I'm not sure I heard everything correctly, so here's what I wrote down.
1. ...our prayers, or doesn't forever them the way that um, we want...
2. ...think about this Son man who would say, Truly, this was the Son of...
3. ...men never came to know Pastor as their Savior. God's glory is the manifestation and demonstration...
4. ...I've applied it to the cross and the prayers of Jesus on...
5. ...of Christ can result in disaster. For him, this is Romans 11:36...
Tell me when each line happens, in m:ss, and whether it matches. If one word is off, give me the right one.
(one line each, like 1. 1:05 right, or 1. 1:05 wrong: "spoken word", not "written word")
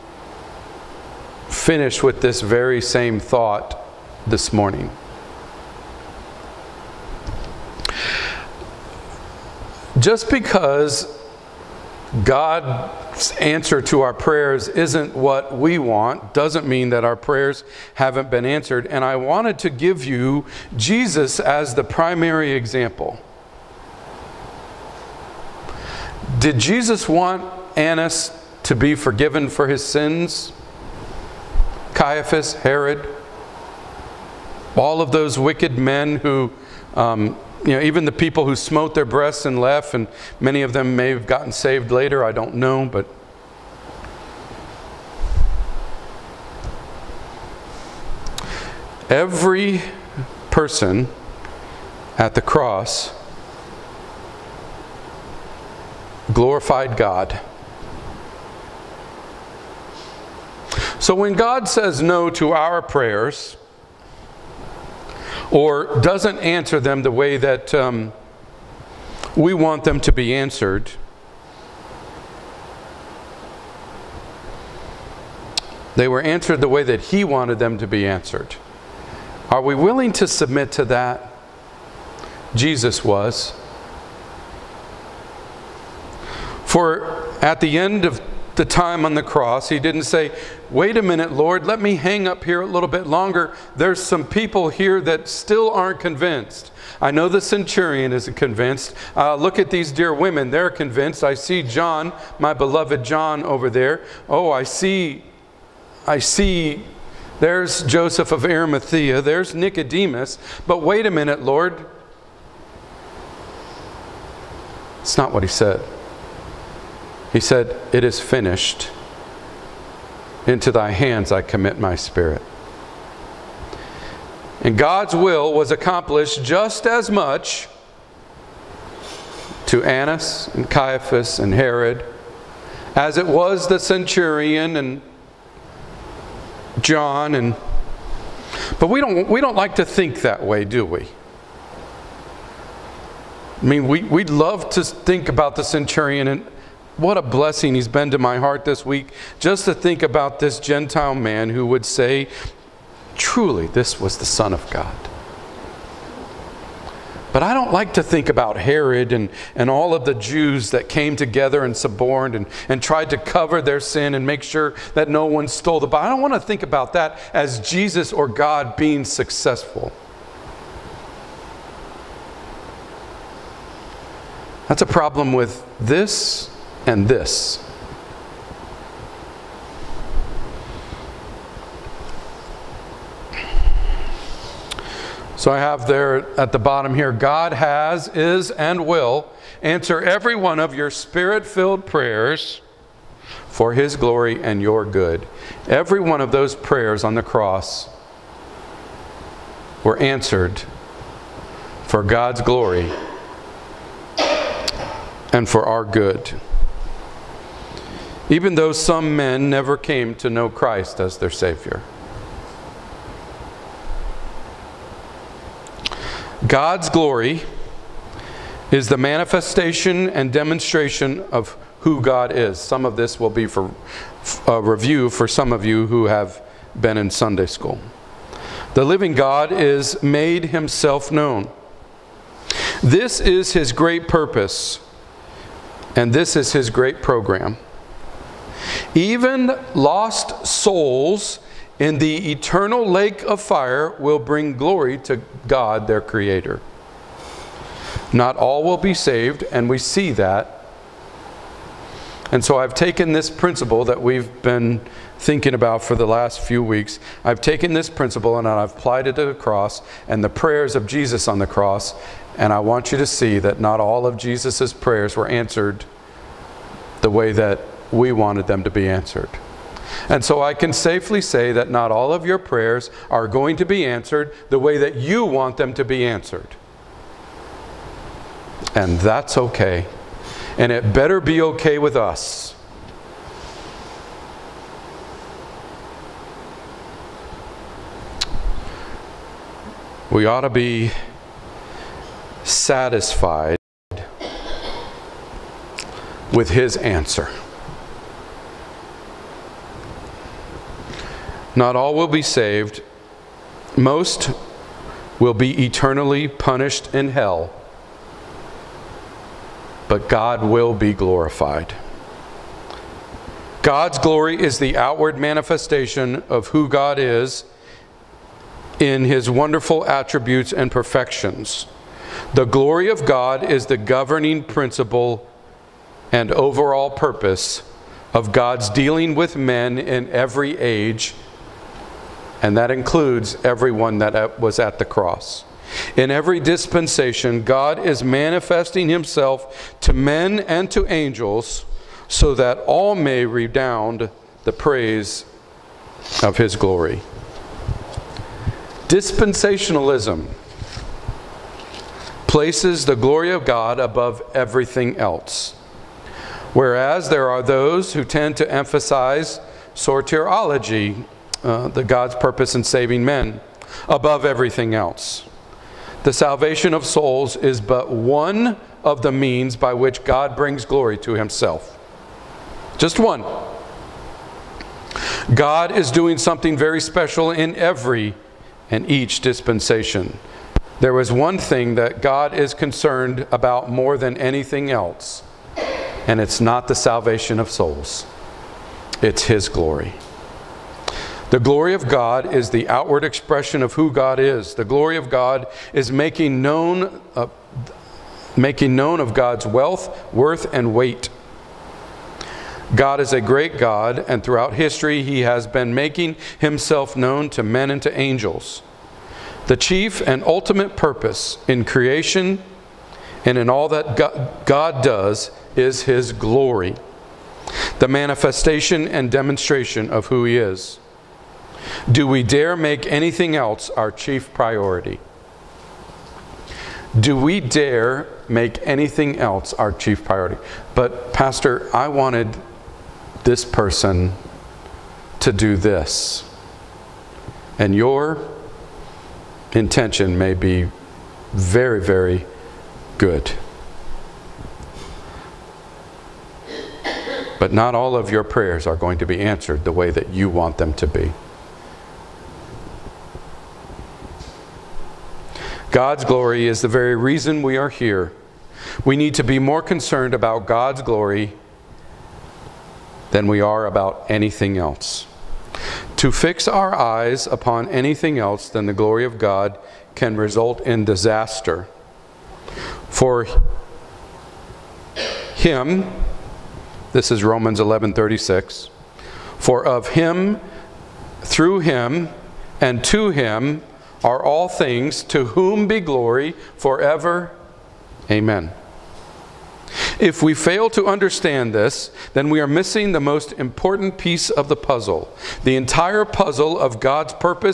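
1. 1:02 wrong: "answer", not "forever"
2. 2:29 wrong: "Gentile", not "Son"
3. 3:29 wrong: "Christ", not "Pastor"
4. 4:18 right
5. 7:49 wrong: "God", not "Christ".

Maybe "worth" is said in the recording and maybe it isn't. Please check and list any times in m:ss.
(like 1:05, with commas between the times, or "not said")
6:40.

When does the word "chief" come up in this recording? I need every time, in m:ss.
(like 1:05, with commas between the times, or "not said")
6:49, 7:03, 7:09.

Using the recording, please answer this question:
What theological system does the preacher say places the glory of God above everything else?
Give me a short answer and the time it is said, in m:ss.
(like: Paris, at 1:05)
Dispensationalism, at 5:48.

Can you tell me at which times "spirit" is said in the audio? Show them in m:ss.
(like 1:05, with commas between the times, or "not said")
2:01, 3:10.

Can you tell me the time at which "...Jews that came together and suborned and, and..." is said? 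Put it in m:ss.
2:40.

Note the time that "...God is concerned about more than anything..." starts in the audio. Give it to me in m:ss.
6:22.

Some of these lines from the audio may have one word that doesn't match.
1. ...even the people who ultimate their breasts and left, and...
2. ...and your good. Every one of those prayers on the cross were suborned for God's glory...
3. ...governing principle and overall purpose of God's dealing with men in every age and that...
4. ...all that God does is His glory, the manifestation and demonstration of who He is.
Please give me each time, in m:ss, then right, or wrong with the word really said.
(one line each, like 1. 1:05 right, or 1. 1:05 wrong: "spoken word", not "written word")
1. 0:37 wrong: "smote", not "ultimate"
2. 3:14 wrong: "answered", not "suborned"
3. 5:23 right
4. 6:53 right.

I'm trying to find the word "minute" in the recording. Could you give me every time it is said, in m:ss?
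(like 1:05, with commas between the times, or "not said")
1:31, 1:51.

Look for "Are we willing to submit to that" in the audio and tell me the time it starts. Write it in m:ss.
1:19.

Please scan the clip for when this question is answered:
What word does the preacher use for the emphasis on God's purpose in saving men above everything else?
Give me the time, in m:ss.
5:59.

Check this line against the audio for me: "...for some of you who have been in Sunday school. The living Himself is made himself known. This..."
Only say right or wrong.
wrong.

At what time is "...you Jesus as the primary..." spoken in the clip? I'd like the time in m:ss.
0:20.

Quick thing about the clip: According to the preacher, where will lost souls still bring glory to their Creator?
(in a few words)
The eternal lake of fire.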